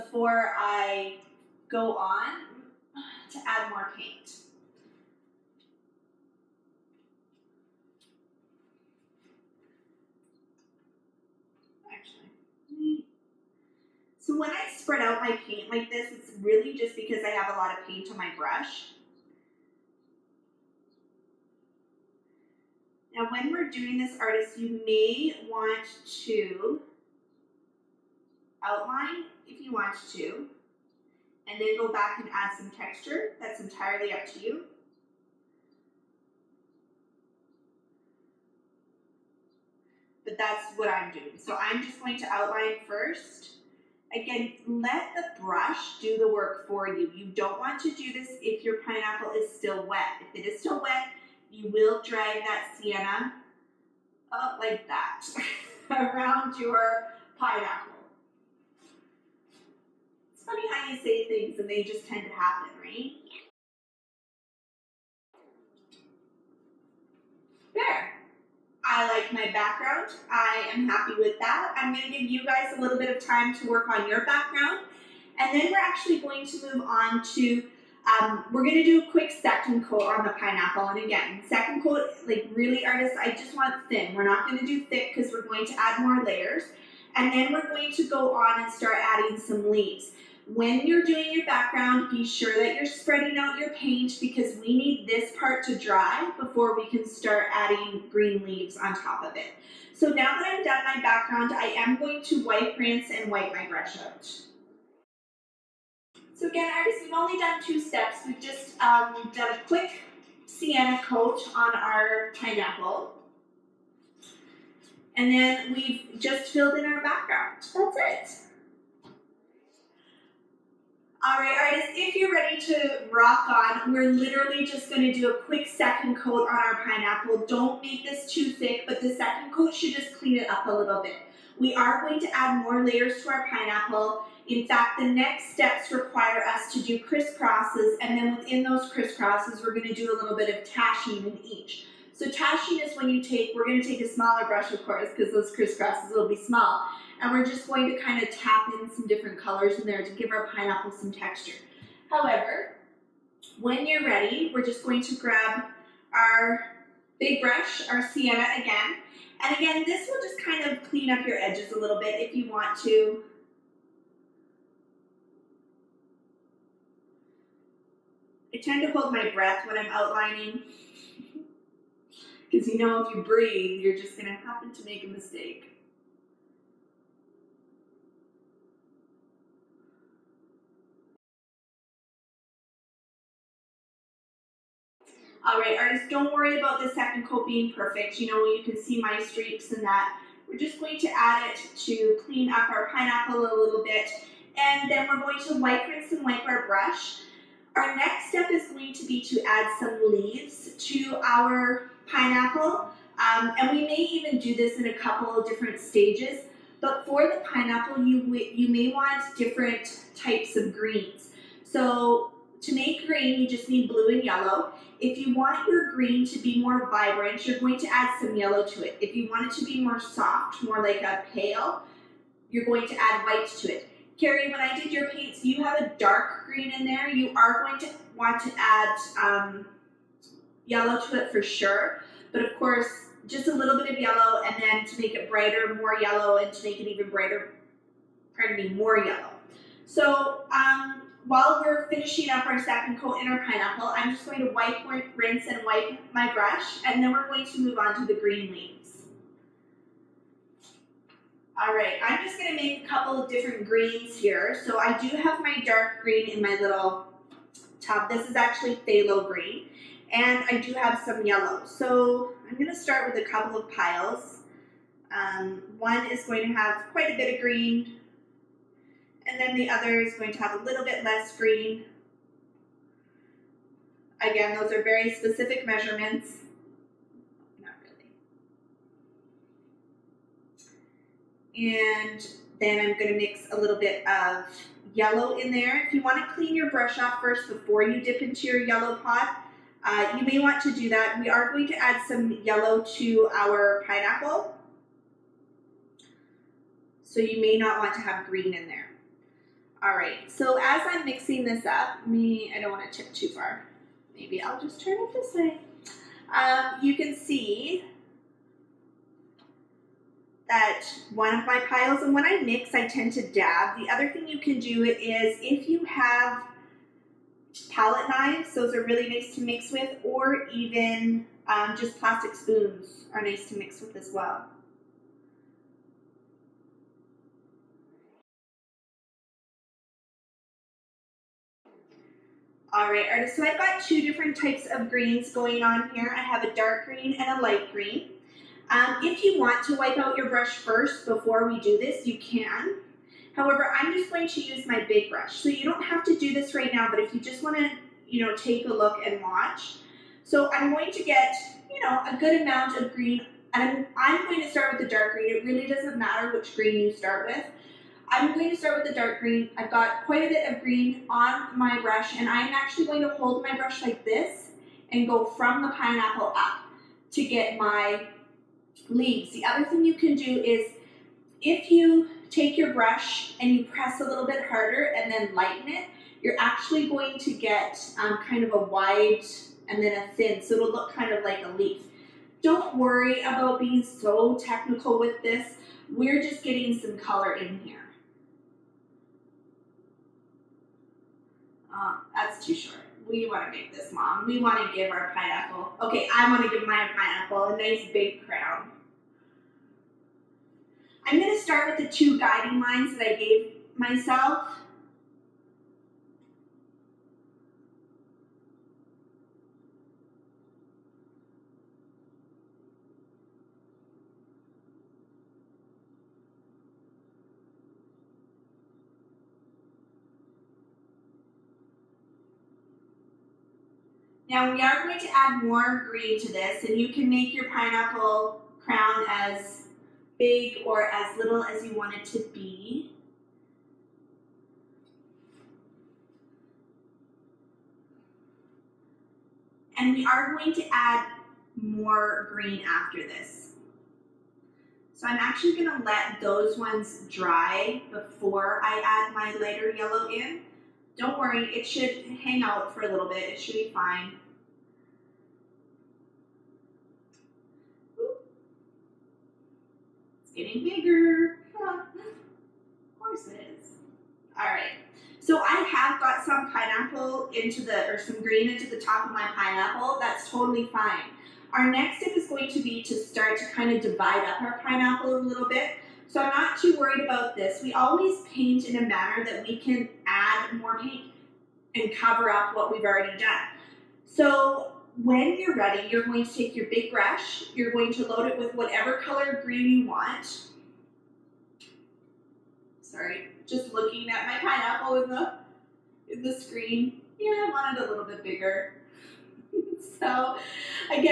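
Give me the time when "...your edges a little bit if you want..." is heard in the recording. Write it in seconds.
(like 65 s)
161 s.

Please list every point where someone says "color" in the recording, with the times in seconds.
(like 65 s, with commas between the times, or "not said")
149 s, 386 s, 488 s.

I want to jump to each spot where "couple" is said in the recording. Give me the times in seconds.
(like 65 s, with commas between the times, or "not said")
204 s, 252 s, 263 s.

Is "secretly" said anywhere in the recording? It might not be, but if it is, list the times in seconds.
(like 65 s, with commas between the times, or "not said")
not said.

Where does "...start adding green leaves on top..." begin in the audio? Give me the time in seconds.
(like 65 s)
97 s.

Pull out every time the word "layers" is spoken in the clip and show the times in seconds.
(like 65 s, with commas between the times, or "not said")
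86 s, 132 s.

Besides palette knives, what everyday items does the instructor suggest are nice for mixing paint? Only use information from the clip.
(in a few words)
plastic spoons.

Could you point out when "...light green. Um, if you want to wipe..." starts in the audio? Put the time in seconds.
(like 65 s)
337 s.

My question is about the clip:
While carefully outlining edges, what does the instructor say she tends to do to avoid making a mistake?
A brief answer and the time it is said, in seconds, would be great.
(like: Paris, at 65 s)
hold my breath, at 168 s.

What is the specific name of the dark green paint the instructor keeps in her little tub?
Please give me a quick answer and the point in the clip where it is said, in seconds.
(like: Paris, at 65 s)
phthalo green, at 258 s.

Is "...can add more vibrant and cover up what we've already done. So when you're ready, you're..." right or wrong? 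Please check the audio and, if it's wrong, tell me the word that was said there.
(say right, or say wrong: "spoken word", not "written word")
wrong: "paint", not "vibrant".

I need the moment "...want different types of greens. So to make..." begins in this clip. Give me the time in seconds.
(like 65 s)
208 s.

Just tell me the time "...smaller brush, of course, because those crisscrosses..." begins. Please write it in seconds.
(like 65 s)
144 s.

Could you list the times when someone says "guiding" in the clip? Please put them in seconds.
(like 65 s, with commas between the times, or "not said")
402 s.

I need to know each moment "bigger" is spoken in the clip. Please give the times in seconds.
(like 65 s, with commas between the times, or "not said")
460 s, 498 s.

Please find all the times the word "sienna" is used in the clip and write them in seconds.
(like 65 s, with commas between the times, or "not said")
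52 s, 110 s, 158 s.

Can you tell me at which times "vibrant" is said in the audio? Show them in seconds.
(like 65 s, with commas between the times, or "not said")
216 s.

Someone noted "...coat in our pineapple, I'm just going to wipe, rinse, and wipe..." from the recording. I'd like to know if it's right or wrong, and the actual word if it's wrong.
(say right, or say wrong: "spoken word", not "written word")
right.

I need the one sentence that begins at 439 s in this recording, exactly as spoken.
And we are going to add more green after this.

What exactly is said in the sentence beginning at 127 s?
Don't make this too thick, but the second coat should just clean it up a little bit.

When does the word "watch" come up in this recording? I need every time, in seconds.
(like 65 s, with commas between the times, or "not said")
349 s.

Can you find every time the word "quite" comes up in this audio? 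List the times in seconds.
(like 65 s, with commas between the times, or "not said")
266 s, 360 s.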